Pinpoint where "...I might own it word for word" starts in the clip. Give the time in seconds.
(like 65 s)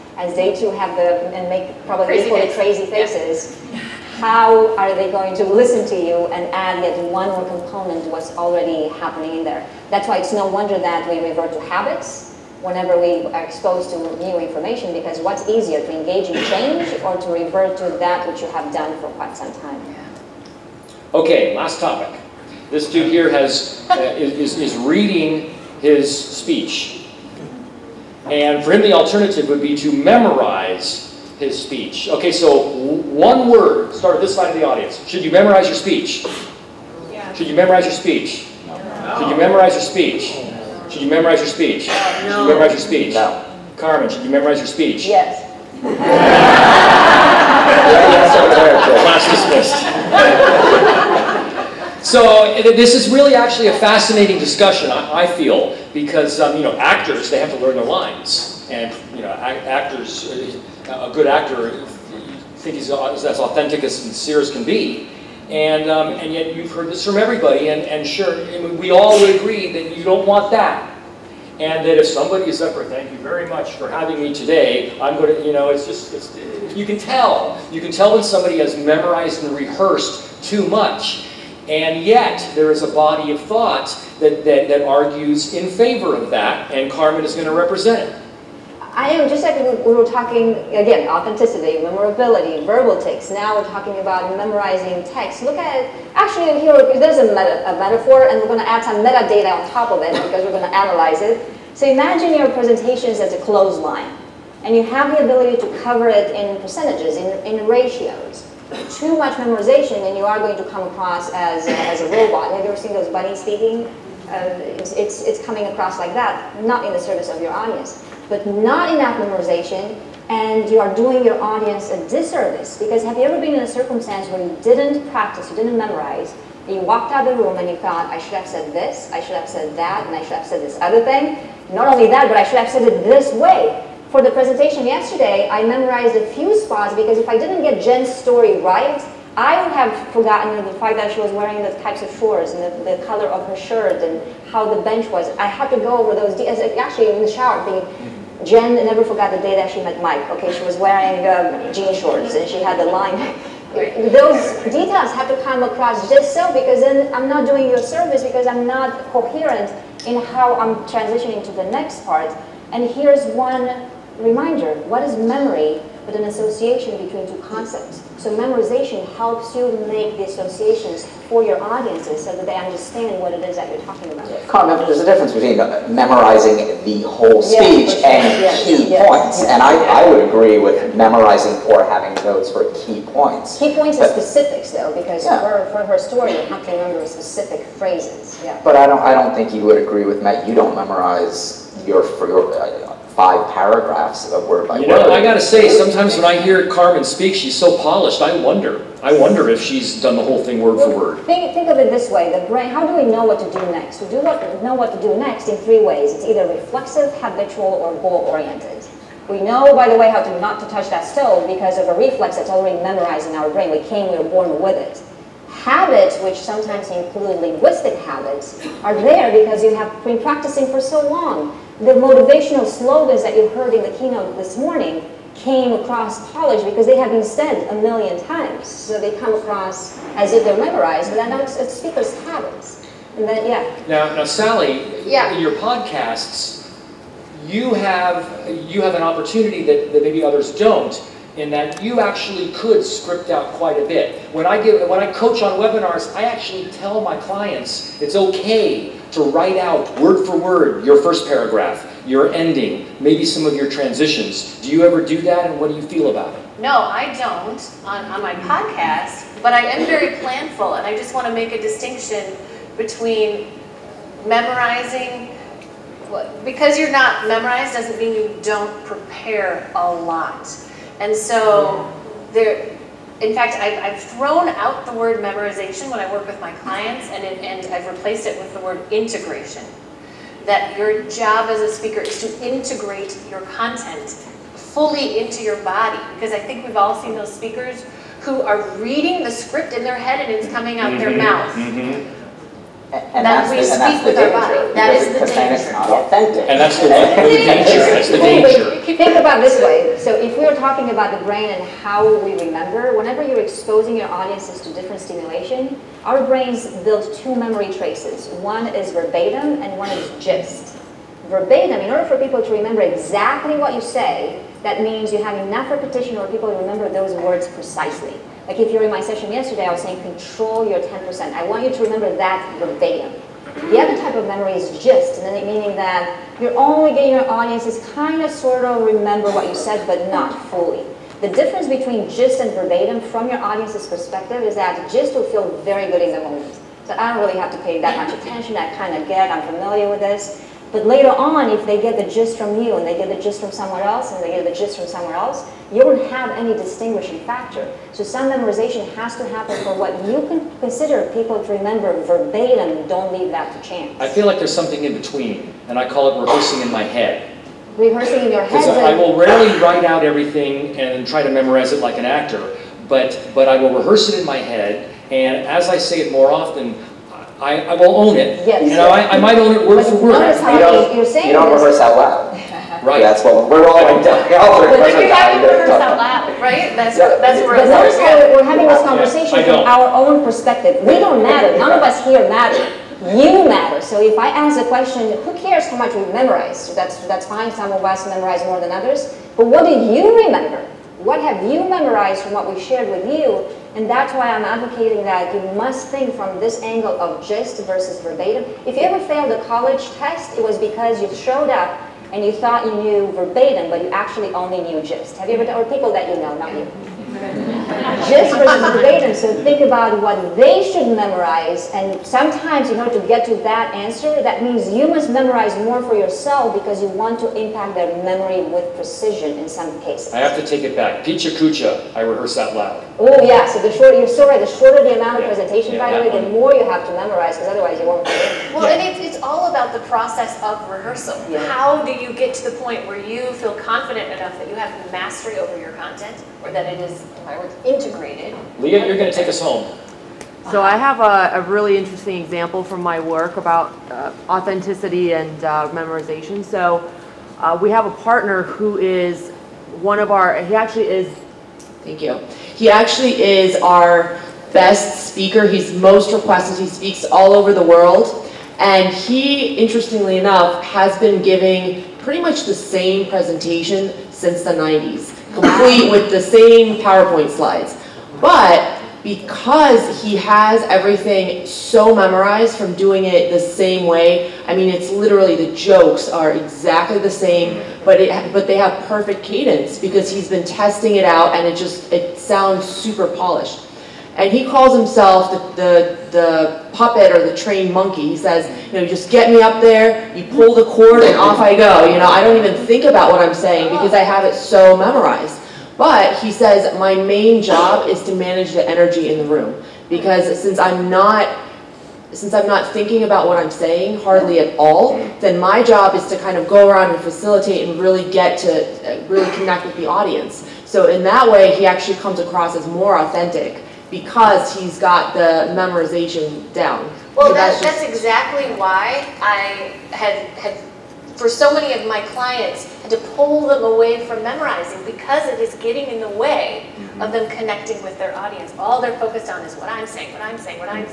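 369 s.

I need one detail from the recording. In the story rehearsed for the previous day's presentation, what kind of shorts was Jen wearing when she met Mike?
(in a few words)
Jean shorts.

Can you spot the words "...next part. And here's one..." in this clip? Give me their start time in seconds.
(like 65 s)
161 s.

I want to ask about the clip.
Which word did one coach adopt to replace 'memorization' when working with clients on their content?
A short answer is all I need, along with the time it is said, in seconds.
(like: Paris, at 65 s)
Integration, at 278 s.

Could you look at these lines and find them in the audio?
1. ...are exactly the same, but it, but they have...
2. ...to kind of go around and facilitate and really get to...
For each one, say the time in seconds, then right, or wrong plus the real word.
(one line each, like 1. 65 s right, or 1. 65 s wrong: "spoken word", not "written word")
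1. 476 s right
2. 506 s right.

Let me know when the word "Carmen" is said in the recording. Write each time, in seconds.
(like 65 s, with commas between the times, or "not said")
43 s, 86 s, 196 s.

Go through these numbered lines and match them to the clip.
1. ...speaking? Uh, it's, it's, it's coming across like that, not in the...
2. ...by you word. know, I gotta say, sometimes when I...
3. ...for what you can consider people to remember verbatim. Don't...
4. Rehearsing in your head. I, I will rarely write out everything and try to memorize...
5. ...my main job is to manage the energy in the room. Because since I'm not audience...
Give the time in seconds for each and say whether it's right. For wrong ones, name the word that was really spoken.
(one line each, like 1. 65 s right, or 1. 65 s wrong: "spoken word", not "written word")
1. 113 s right
2. 194 s right
3. 349 s right
4. 357 s right
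5. 496 s wrong: "since", not "audience".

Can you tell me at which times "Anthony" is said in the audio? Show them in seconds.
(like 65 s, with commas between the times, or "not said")
not said.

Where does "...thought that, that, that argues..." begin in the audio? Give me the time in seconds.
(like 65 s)
83 s.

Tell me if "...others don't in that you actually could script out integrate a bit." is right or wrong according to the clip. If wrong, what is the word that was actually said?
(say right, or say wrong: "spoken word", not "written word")
wrong: "quite", not "integrate".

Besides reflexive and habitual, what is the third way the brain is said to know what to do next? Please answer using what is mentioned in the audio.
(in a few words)
Goal-oriented.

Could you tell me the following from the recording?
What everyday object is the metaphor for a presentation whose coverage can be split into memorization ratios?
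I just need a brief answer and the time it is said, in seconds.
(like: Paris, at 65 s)
Clothesline, at 103 s.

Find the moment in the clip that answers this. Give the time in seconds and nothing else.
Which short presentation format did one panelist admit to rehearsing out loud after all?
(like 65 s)
421 s.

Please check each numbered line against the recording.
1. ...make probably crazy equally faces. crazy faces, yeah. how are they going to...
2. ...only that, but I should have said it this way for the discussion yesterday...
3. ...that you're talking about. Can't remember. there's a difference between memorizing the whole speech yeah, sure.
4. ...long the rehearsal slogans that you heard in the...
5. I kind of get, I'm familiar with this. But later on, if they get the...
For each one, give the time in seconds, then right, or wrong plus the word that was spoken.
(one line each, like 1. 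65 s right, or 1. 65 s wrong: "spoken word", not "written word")
1. 1 s right
2. 131 s wrong: "presentation", not "discussion"
3. 173 s right
4. 221 s wrong: "motivational", not "rehearsal"
5. 338 s right.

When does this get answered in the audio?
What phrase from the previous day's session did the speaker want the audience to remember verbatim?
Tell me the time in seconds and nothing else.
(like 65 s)
320 s.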